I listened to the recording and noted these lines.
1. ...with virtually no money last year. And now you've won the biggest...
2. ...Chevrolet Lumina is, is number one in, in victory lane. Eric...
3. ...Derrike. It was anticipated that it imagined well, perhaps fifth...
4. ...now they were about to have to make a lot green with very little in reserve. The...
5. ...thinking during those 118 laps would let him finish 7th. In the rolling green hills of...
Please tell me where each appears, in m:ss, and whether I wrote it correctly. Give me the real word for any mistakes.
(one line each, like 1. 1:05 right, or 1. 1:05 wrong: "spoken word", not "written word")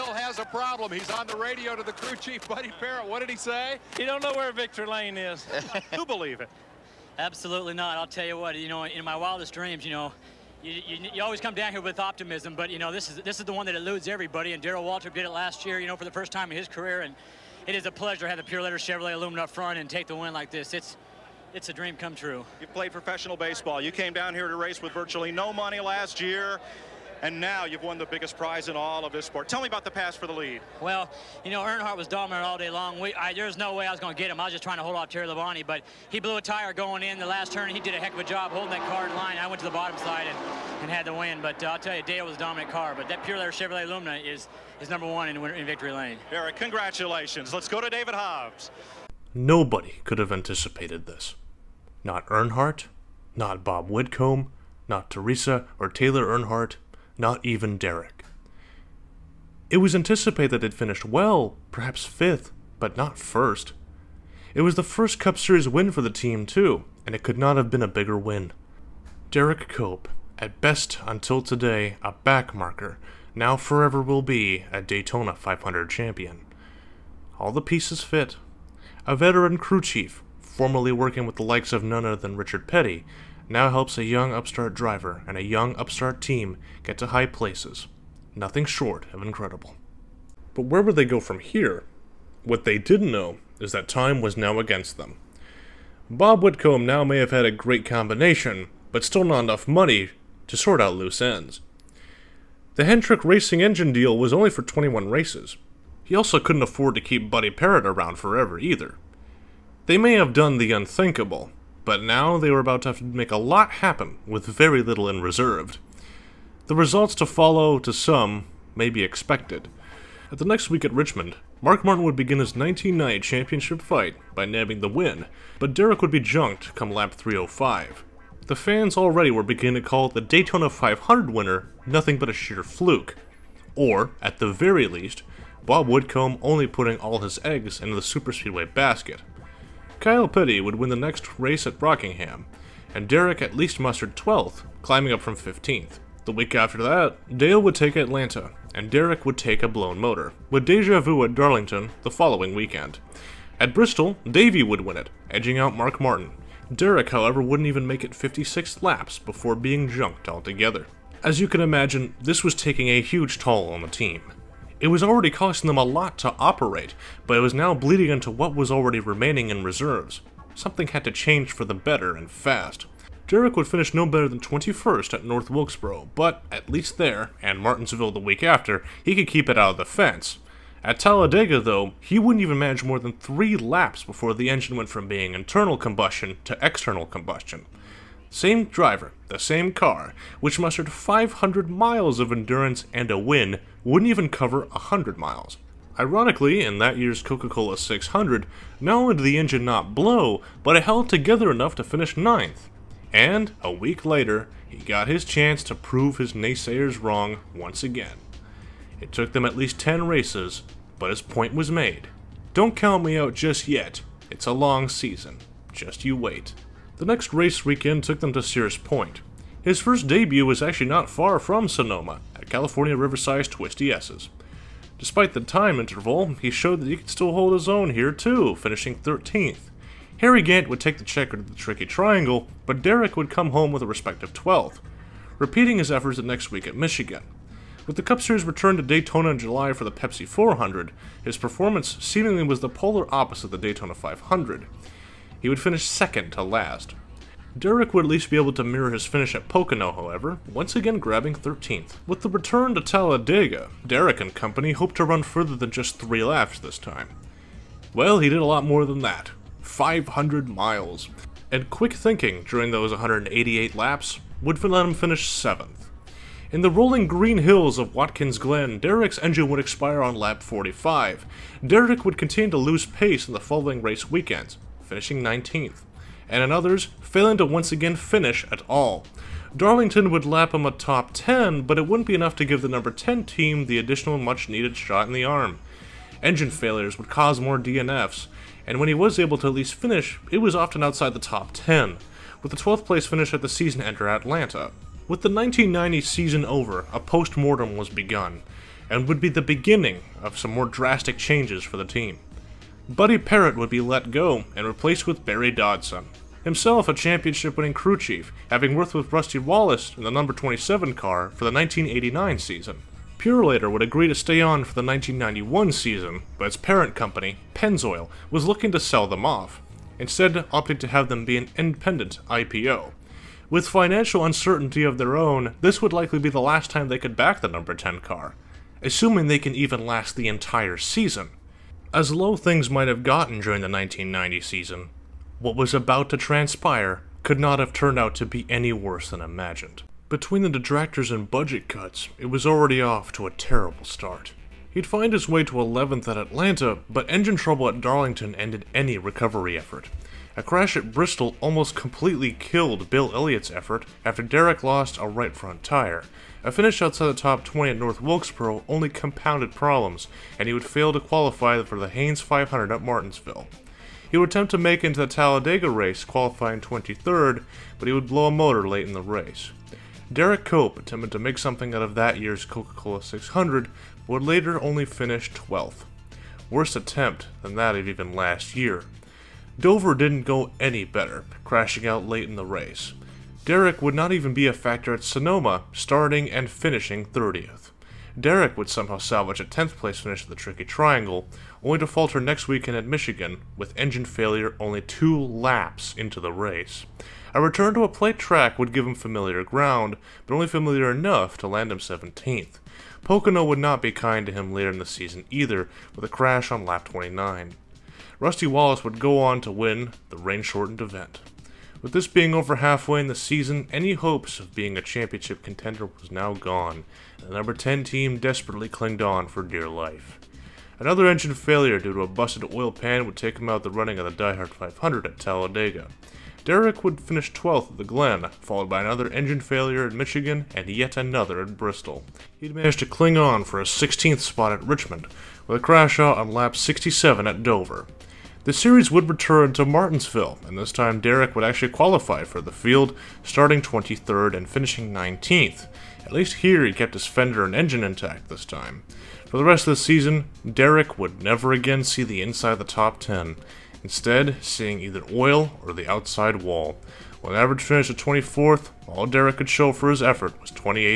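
1. 0:24 right
2. 0:43 right
3. 0:57 wrong: "finished", not "imagined"
4. 1:52 wrong: "happen", not "green"
5. 4:21 wrong: "188", not "118".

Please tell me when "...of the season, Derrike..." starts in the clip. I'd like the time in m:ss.
7:29.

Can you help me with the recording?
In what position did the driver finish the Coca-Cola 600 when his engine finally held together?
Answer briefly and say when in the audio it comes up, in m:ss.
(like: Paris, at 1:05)
9th, at 3:22.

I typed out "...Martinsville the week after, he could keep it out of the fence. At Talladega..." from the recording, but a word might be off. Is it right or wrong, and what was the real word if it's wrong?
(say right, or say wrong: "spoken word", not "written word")
right.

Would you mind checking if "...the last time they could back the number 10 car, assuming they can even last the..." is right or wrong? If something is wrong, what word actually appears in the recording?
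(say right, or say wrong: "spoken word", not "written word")
right.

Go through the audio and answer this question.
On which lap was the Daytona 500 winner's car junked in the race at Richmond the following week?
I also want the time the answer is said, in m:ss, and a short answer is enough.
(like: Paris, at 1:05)
305, at 2:06.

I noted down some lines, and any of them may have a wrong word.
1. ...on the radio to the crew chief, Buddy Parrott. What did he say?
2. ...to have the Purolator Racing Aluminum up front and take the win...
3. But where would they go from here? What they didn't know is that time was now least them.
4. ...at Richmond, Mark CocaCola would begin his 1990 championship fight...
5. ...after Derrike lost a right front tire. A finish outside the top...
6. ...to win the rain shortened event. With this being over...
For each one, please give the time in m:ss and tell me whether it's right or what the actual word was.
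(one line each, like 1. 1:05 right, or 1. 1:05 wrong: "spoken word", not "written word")
1. 0:01 right
2. 0:18 wrong: "Chevrolet", not "Racing"
3. 1:30 wrong: "against", not "least"
4. 2:00 wrong: "Martin", not "CocaCola"
5. 5:54 right
6. 6:49 right.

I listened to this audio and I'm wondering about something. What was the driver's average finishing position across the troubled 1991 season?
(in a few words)
24th.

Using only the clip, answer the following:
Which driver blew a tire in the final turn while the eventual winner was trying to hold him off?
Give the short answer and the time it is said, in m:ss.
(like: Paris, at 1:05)
Terry Labonte, at 0:35.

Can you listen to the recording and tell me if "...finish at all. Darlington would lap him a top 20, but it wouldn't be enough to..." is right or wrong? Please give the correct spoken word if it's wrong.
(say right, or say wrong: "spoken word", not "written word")
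wrong: "10", not "20".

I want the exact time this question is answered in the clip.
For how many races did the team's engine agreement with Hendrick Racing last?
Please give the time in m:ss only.
1:44.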